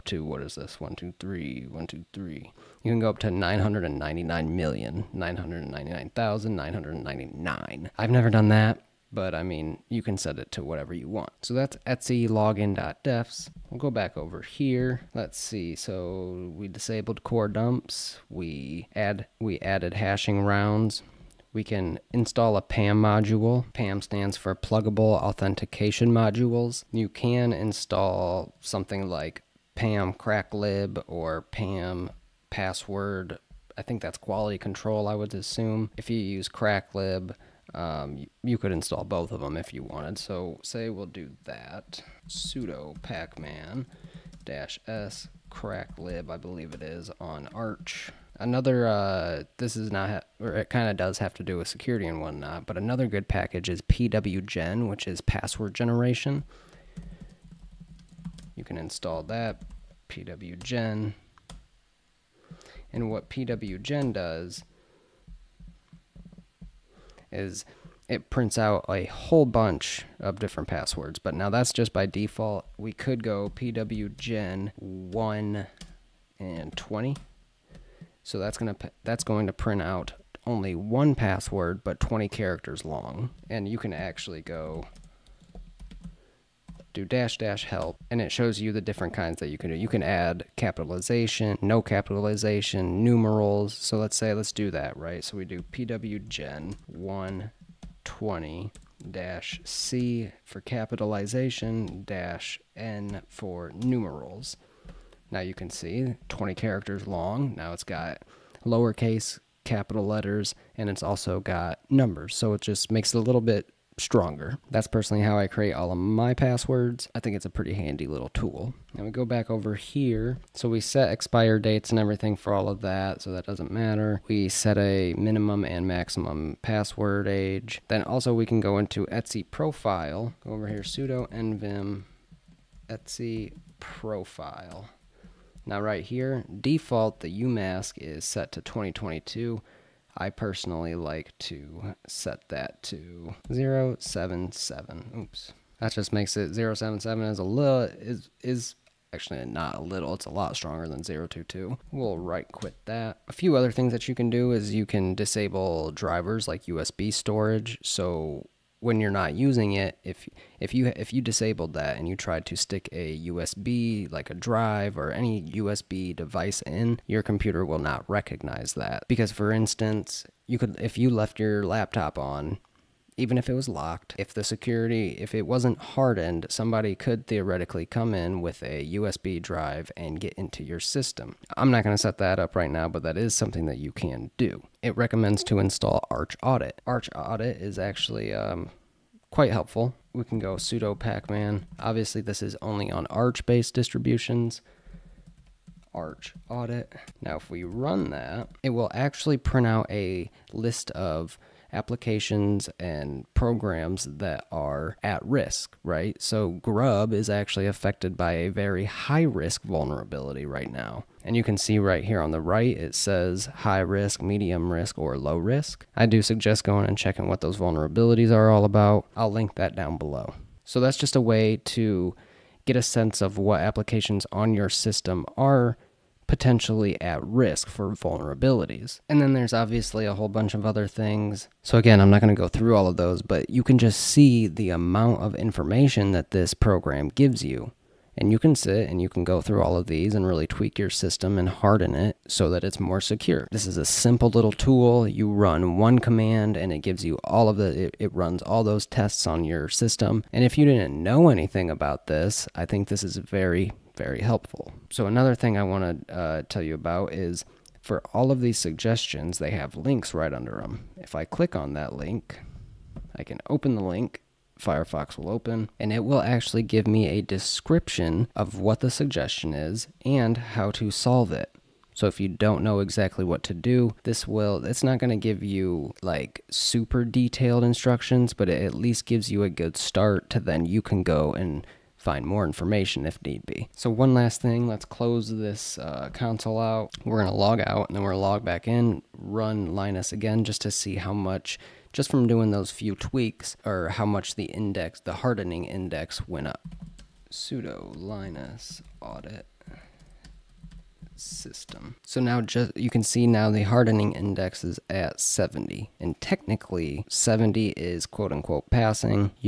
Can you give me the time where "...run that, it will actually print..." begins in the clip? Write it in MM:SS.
03:17.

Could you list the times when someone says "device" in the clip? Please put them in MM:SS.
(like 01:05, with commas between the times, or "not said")
02:46.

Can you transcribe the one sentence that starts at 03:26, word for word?
So Grub is actually affected by a very high risk vulnerability right now.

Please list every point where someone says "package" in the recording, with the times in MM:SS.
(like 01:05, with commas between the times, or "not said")
00:53.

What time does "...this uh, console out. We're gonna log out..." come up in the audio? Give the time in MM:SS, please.
04:45.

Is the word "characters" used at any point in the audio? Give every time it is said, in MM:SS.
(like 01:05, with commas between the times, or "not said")
01:22, 01:46.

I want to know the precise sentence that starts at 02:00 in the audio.
So we set expire dates and everything for all of that, so that doesn't matter.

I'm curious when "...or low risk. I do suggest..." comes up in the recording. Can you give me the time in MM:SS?
03:34.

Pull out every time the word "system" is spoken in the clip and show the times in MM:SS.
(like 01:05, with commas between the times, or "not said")
03:00, 03:44, 04:00, 04:09, 05:01.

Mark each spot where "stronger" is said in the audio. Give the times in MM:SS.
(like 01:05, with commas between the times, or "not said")
01:53, 02:30.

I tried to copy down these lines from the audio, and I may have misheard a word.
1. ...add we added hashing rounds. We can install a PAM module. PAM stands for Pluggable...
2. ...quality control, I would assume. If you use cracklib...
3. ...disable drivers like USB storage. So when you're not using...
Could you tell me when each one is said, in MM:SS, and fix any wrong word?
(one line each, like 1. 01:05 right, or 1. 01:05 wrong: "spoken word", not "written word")
1. 00:18 right
2. 00:34 right
3. 02:35 right.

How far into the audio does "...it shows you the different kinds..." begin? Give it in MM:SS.
01:28.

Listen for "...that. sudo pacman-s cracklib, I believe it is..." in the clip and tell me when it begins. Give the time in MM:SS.
00:41.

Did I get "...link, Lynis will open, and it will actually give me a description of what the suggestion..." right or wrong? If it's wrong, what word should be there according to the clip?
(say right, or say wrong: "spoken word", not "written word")
wrong: "Firefox", not "Lynis".